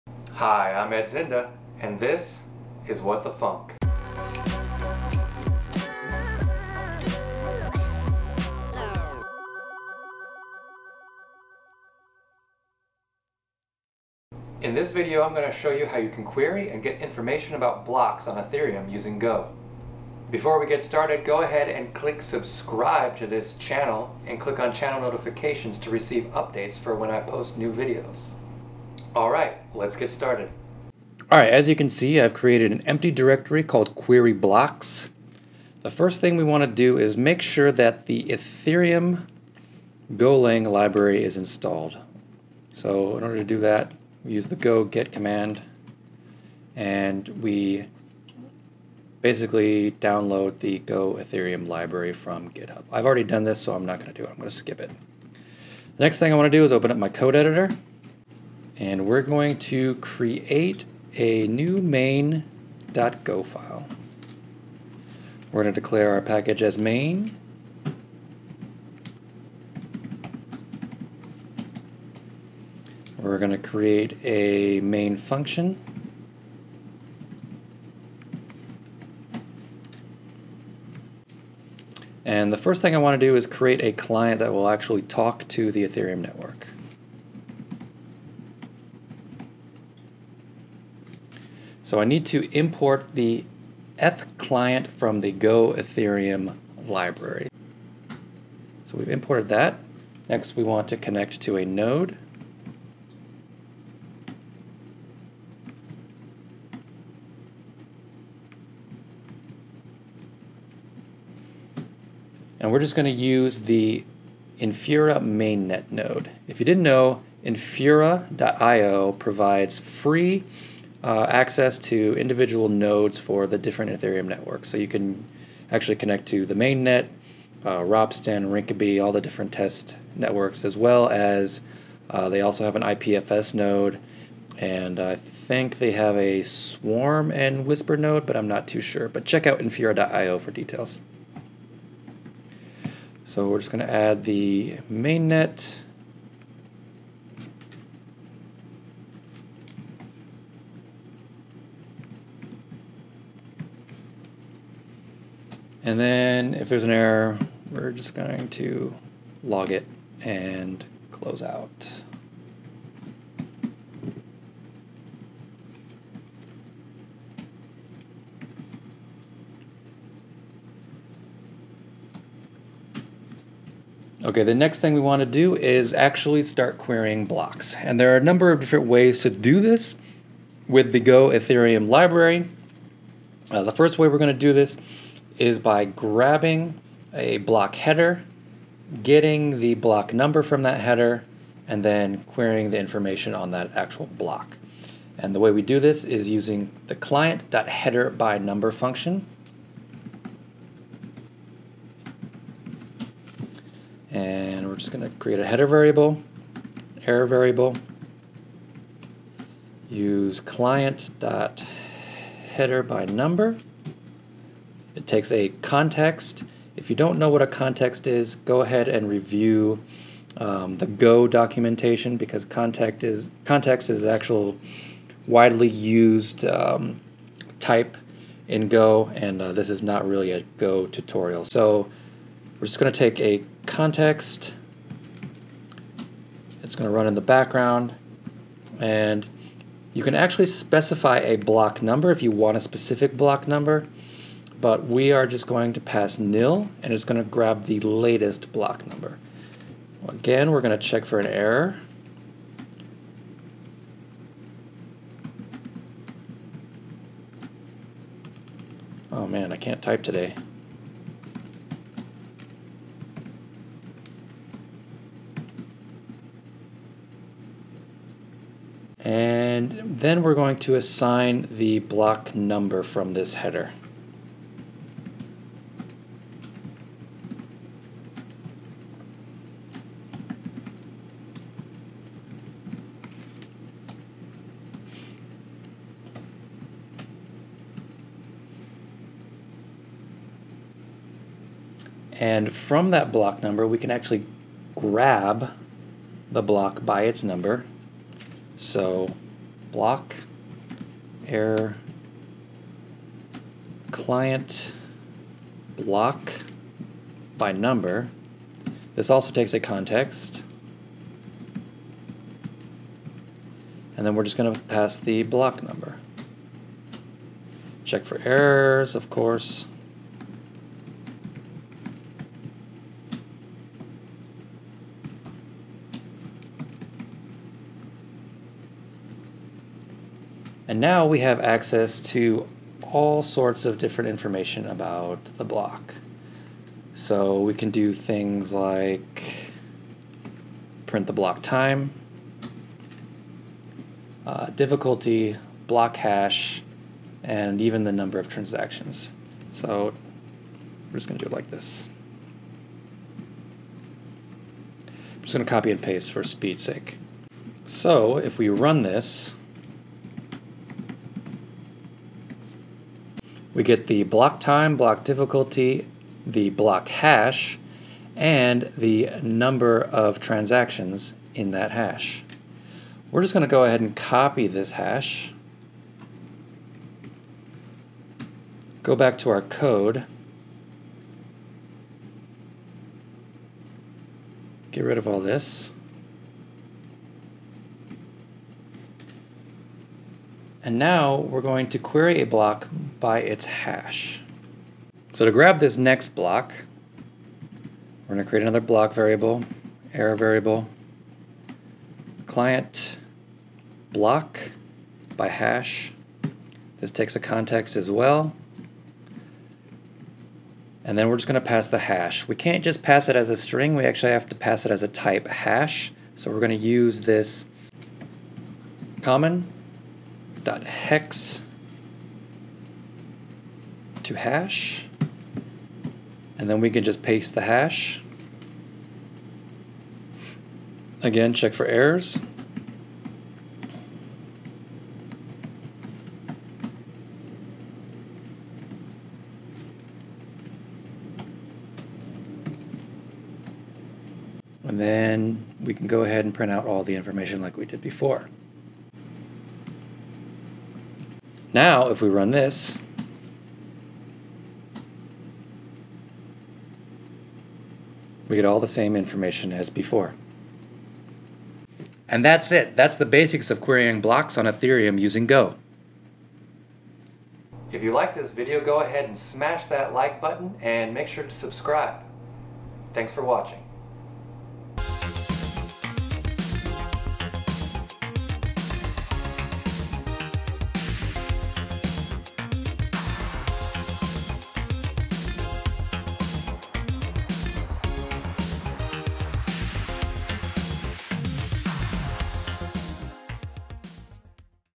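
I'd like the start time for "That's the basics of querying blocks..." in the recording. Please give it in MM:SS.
07:42.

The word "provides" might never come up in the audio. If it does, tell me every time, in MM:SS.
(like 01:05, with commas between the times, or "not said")
01:59.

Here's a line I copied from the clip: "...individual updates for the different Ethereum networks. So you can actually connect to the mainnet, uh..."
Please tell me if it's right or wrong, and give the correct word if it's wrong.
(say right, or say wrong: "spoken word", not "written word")
wrong: "nodes", not "updates".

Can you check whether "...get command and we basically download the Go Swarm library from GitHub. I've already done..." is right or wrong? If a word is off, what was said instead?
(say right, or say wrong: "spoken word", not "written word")
wrong: "Ethereum", not "Swarm".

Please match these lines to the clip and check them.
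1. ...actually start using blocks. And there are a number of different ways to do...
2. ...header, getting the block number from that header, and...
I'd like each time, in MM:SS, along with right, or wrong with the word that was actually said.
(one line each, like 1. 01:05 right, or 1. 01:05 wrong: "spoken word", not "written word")
1. 02:55 wrong: "querying", not "using"
2. 03:07 right.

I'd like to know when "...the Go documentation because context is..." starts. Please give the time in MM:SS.
03:40.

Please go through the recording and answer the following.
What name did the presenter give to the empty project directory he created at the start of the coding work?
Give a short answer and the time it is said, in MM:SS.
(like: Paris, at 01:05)
query blocks, at 00:33.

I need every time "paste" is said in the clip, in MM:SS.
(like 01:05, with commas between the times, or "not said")
05:55, 07:07.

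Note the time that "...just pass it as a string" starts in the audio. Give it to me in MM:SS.
06:52.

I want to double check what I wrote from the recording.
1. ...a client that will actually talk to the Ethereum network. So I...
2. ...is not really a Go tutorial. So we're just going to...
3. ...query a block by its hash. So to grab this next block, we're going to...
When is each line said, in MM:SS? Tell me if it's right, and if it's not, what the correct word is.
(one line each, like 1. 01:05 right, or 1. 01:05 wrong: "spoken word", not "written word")
1. 01:23 right
2. 03:49 right
3. 06:31 right.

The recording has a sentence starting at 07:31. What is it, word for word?
Now, if we run this, we get all the same information as before.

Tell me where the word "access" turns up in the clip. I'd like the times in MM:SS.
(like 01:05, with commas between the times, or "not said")
02:01, 05:31.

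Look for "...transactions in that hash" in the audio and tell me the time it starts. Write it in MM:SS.
06:10.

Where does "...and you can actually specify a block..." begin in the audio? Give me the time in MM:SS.
03:58.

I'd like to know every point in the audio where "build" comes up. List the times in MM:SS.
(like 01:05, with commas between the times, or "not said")
not said.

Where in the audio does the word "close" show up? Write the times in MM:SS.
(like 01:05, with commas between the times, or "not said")
02:41.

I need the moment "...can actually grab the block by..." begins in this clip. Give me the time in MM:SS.
04:53.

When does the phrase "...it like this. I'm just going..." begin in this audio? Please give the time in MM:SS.
05:51.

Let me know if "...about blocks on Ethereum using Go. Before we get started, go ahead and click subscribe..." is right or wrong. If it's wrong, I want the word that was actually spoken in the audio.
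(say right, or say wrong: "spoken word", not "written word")
right.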